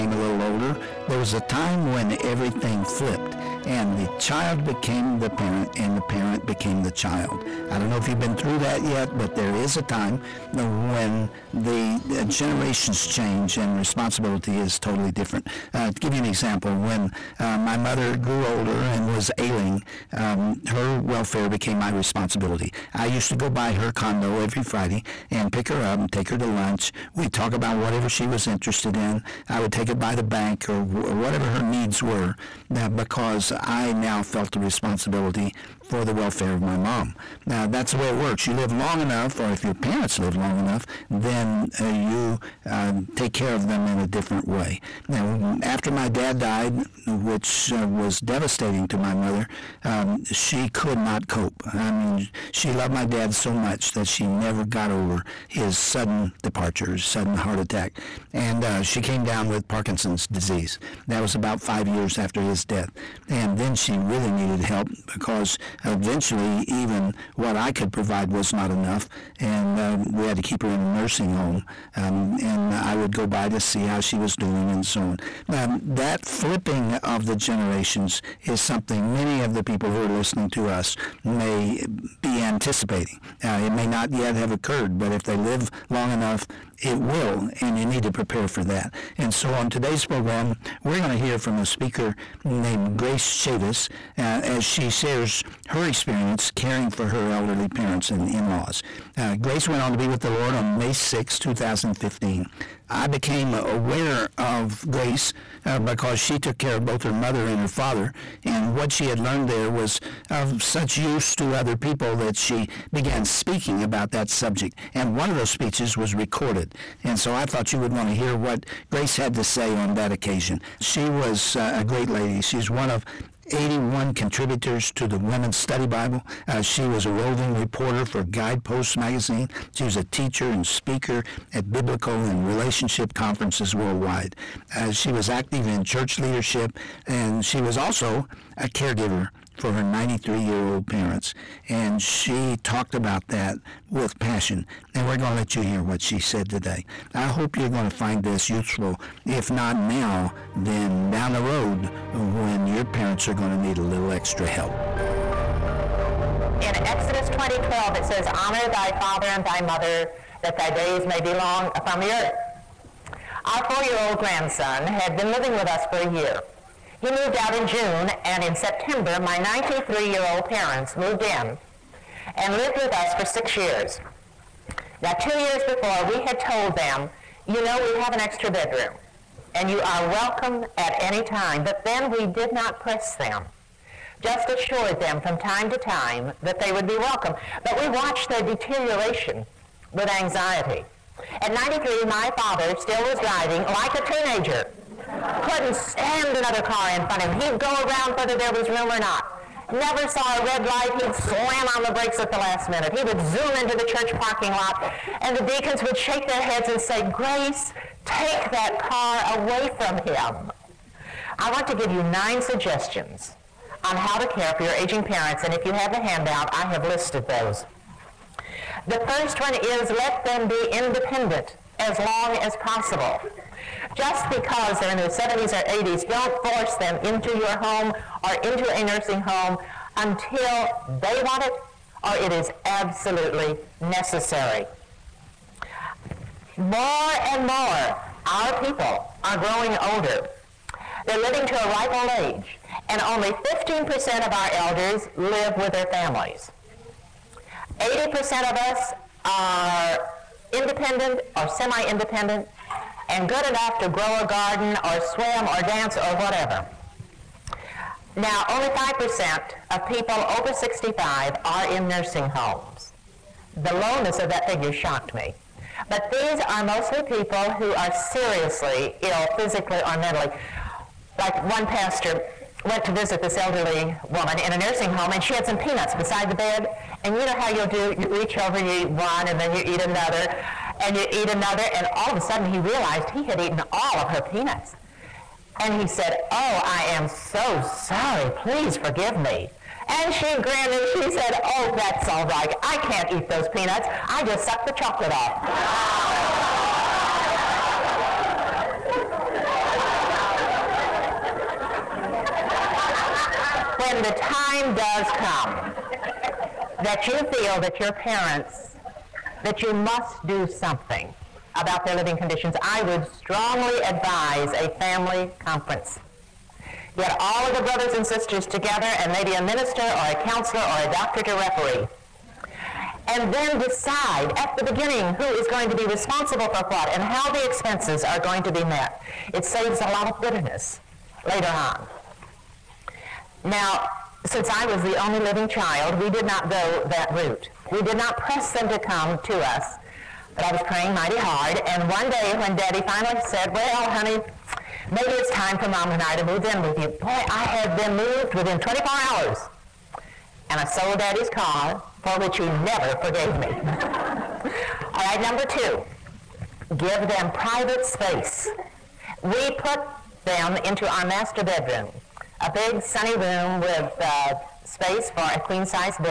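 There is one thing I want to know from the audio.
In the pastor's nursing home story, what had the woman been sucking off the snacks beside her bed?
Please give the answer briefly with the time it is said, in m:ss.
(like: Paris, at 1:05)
Chocolate, at 4:54.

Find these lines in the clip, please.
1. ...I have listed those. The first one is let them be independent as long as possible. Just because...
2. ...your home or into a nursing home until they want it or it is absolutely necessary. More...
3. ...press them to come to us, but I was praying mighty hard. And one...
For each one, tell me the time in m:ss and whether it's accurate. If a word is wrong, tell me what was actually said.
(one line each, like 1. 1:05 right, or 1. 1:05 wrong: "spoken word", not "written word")
1. 3:36 right
2. 3:47 right
3. 5:38 right.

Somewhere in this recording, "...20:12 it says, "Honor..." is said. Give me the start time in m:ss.
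2:37.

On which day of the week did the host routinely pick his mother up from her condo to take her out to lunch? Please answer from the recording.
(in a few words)
Friday.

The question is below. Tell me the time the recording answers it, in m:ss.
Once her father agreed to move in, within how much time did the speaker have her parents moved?
5:48.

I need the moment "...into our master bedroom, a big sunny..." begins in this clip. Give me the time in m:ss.
6:00.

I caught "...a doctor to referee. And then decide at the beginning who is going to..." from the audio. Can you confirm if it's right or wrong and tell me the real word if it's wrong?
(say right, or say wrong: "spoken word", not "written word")
right.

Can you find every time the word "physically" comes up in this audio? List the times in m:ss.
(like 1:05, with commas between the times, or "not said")
4:29.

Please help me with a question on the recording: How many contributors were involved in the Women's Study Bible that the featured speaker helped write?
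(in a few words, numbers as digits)
81.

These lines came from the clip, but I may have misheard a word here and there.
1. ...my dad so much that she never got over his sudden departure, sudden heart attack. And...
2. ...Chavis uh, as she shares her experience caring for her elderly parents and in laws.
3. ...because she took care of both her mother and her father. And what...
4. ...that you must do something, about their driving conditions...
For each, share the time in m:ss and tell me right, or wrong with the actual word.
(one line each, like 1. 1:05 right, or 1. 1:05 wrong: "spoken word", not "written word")
1. 0:52 right
2. 1:33 right
3. 1:45 right
4. 5:09 wrong: "living", not "driving".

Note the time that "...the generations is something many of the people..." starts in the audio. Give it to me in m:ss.
1:17.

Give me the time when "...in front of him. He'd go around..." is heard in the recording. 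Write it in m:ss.
3:16.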